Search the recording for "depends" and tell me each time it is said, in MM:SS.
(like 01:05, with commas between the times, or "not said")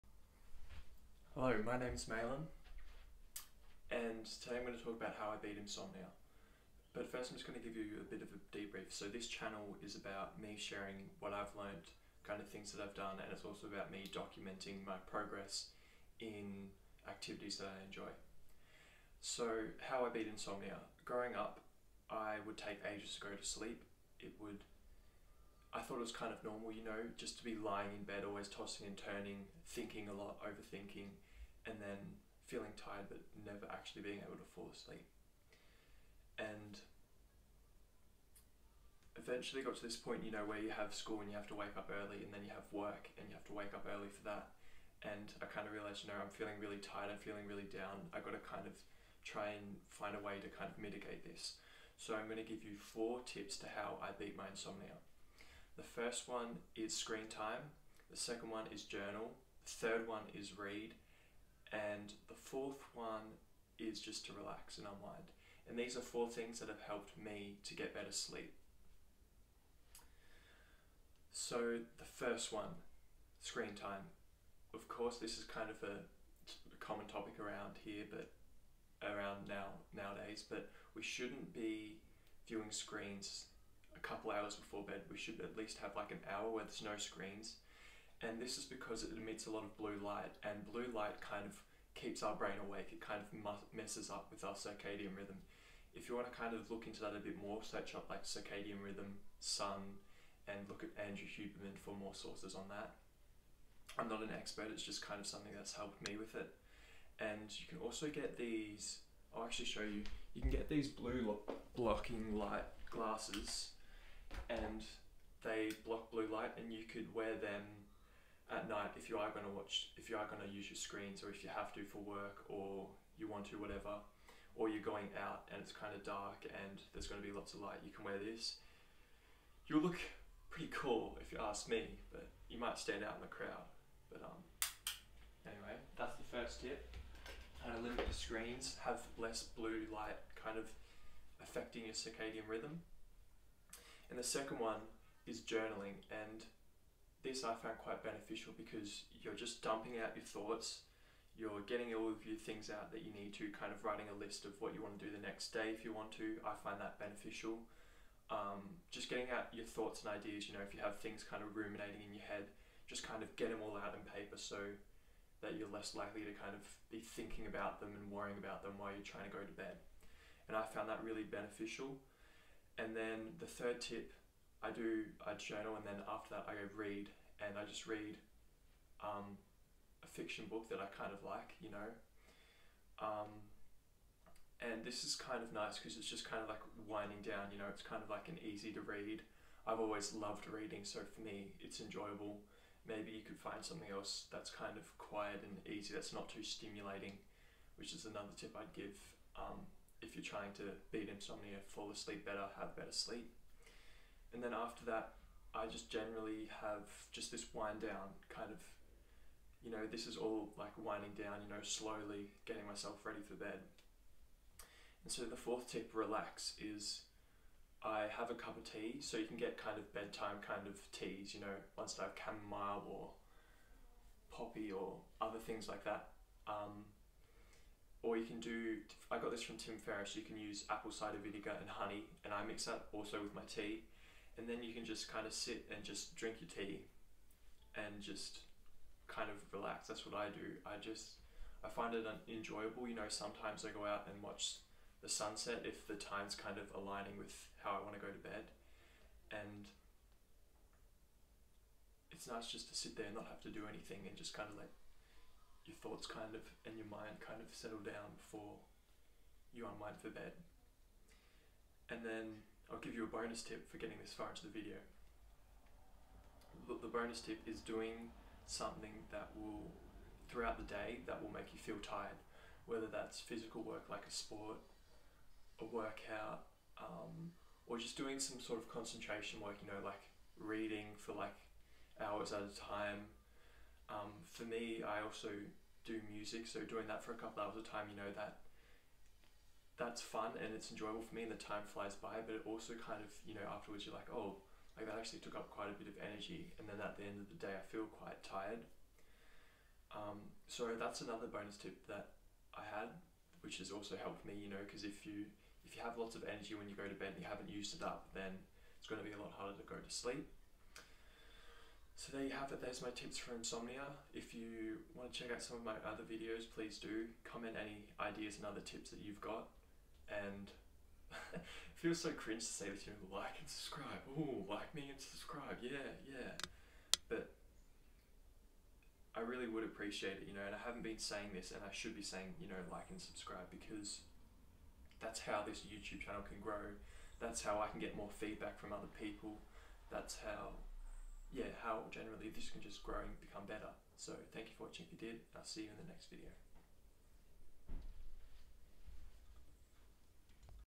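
not said.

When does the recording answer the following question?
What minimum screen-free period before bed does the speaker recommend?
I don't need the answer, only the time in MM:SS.
01:26.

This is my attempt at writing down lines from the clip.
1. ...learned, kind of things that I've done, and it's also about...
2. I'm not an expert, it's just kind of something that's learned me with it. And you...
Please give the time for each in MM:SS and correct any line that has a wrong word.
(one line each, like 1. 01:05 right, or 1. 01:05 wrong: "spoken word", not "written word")
1. 00:11 right
2. 01:43 wrong: "helped", not "learned".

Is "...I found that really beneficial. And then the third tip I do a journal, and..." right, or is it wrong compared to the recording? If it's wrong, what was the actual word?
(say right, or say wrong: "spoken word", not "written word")
right.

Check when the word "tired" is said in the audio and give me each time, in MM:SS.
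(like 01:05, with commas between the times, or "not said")
00:32, 00:46, 04:31, 04:58.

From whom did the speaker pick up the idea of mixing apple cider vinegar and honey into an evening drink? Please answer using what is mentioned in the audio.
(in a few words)
Tim Ferriss.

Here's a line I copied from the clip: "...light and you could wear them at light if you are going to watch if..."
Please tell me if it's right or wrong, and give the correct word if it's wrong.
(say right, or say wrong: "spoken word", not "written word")
wrong: "night", not "light".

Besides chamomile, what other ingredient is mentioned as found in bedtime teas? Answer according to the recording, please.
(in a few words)
poppy.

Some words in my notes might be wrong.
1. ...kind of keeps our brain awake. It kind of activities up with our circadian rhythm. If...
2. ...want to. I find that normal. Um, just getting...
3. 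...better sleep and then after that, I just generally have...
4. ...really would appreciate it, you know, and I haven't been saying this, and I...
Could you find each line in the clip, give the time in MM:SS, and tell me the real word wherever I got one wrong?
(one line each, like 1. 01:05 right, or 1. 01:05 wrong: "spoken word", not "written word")
1. 01:31 wrong: "messes", not "activities"
2. 02:35 wrong: "beneficial", not "normal"
3. 03:22 right
4. 05:29 right.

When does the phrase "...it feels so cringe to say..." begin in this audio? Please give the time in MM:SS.
05:21.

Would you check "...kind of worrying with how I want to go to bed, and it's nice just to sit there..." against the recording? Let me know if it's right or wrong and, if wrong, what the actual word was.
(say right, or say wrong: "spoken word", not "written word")
wrong: "aligning", not "worrying".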